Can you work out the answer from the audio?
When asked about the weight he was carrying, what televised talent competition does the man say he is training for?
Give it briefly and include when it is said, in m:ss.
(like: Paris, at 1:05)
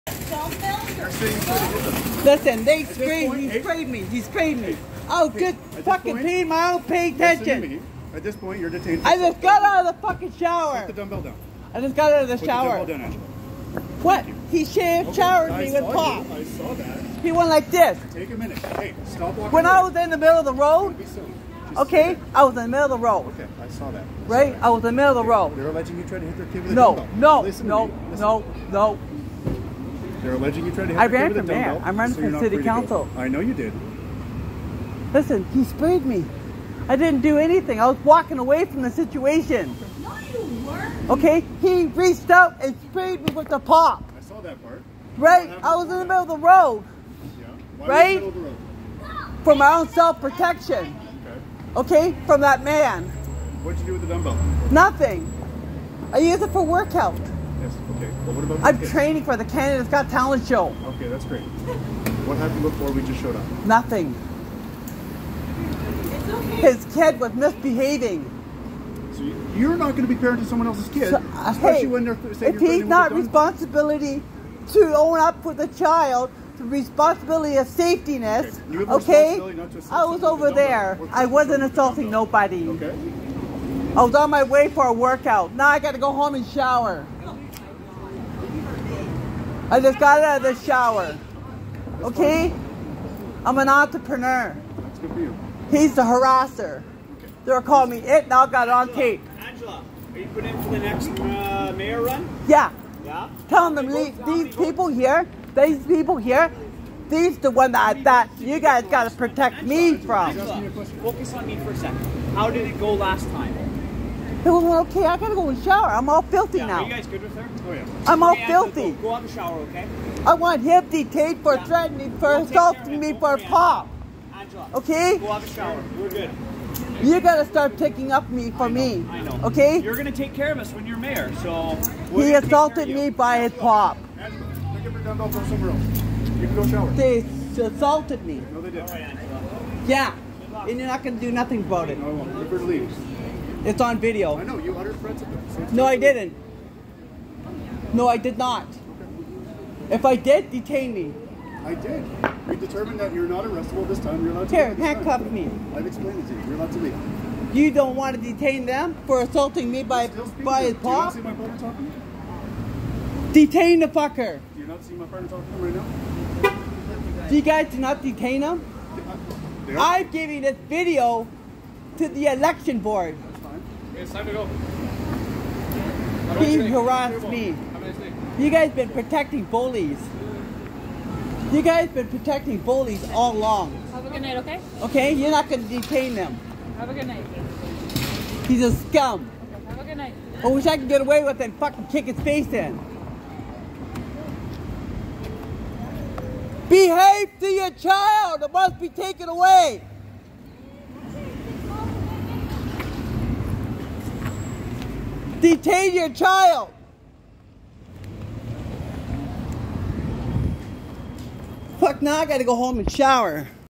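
Canada's Got Talent, at 0:59.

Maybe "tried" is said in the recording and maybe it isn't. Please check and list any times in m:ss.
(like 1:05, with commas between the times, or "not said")
0:26, 0:30.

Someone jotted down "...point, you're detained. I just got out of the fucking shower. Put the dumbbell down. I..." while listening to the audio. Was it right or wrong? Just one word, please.
right.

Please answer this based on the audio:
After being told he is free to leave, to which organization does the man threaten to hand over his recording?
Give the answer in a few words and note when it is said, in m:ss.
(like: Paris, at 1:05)
Election board, at 2:52.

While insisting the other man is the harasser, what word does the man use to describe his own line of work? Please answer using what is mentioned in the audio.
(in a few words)
Entrepreneur.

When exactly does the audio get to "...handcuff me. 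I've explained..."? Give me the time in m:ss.
2:34.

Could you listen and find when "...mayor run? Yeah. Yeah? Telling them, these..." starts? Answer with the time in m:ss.
1:41.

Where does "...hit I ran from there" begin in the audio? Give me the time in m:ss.
0:30.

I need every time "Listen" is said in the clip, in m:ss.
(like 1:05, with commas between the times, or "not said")
0:02, 0:35.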